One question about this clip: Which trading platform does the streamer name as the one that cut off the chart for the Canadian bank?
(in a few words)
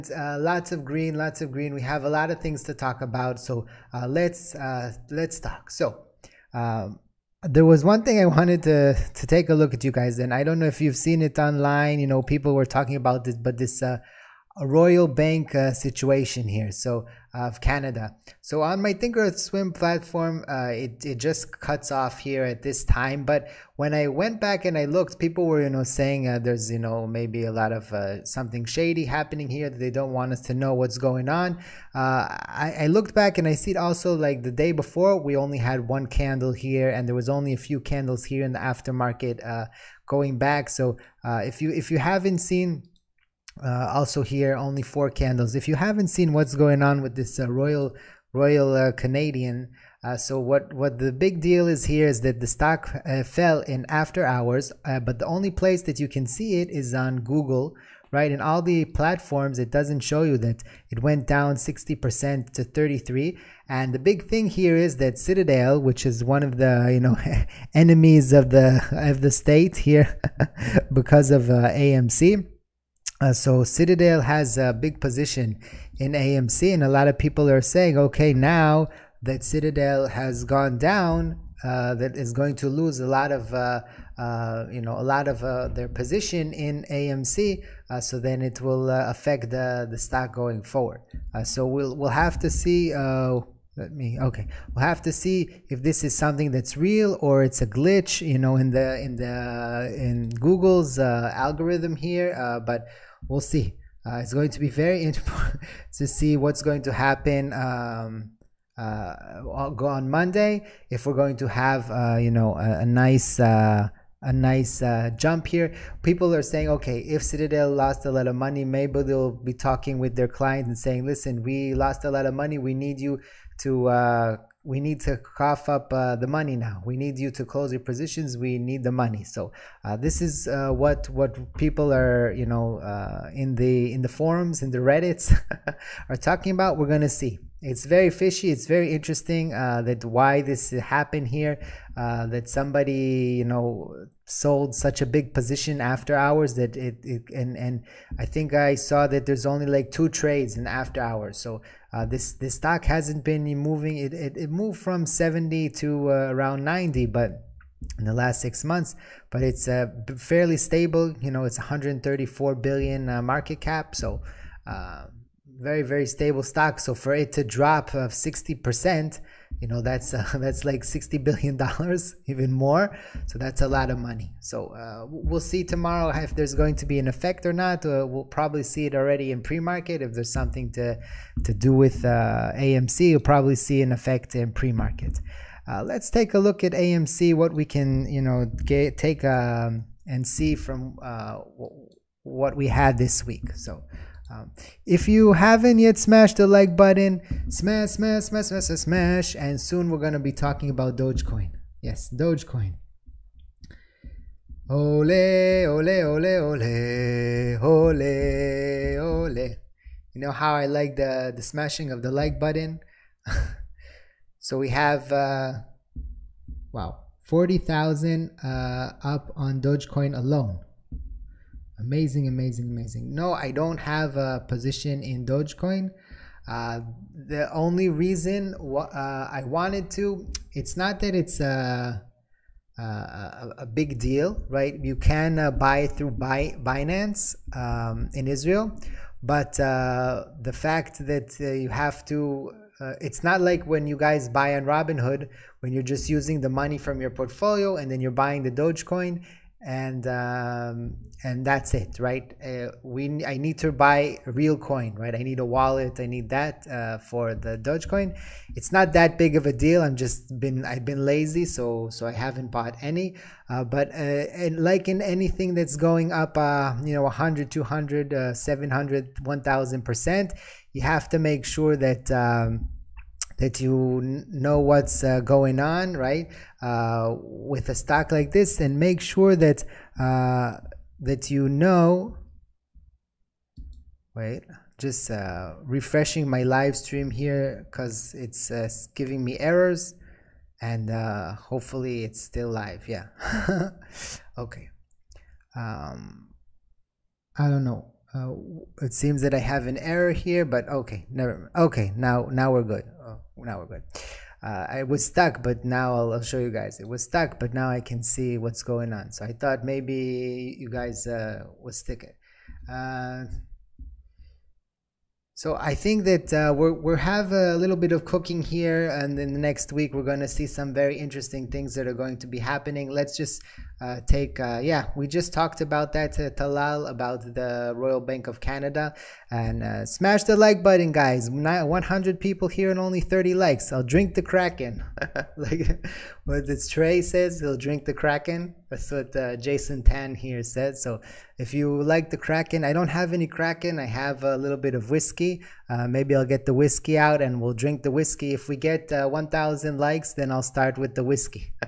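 Thinkorswim.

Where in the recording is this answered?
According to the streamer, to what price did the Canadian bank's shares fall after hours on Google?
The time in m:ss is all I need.
1:02.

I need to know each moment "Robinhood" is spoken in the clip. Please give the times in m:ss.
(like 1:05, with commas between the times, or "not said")
4:04.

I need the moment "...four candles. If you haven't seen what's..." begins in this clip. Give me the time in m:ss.
0:44.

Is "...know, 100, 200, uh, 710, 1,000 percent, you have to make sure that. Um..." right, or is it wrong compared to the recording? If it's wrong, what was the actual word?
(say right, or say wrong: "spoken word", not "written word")
wrong: "700", not "710".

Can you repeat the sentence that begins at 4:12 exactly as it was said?
Uh, we I need to buy real coin, right?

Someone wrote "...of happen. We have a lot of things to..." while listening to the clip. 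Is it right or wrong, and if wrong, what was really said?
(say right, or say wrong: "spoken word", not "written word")
wrong: "green", not "happen".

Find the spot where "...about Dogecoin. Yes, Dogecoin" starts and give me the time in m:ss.
3:20.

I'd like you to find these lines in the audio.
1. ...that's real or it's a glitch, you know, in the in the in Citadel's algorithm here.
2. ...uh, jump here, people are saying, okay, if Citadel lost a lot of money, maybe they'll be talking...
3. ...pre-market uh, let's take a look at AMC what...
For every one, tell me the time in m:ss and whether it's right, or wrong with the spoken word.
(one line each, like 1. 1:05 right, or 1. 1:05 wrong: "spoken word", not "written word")
1. 1:36 wrong: "Google", not "Citadel"
2. 1:54 right
3. 3:04 right.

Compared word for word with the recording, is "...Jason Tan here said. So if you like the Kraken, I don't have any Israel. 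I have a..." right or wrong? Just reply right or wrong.
wrong.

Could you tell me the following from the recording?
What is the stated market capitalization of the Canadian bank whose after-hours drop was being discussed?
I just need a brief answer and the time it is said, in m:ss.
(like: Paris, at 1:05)
134 billion, at 2:41.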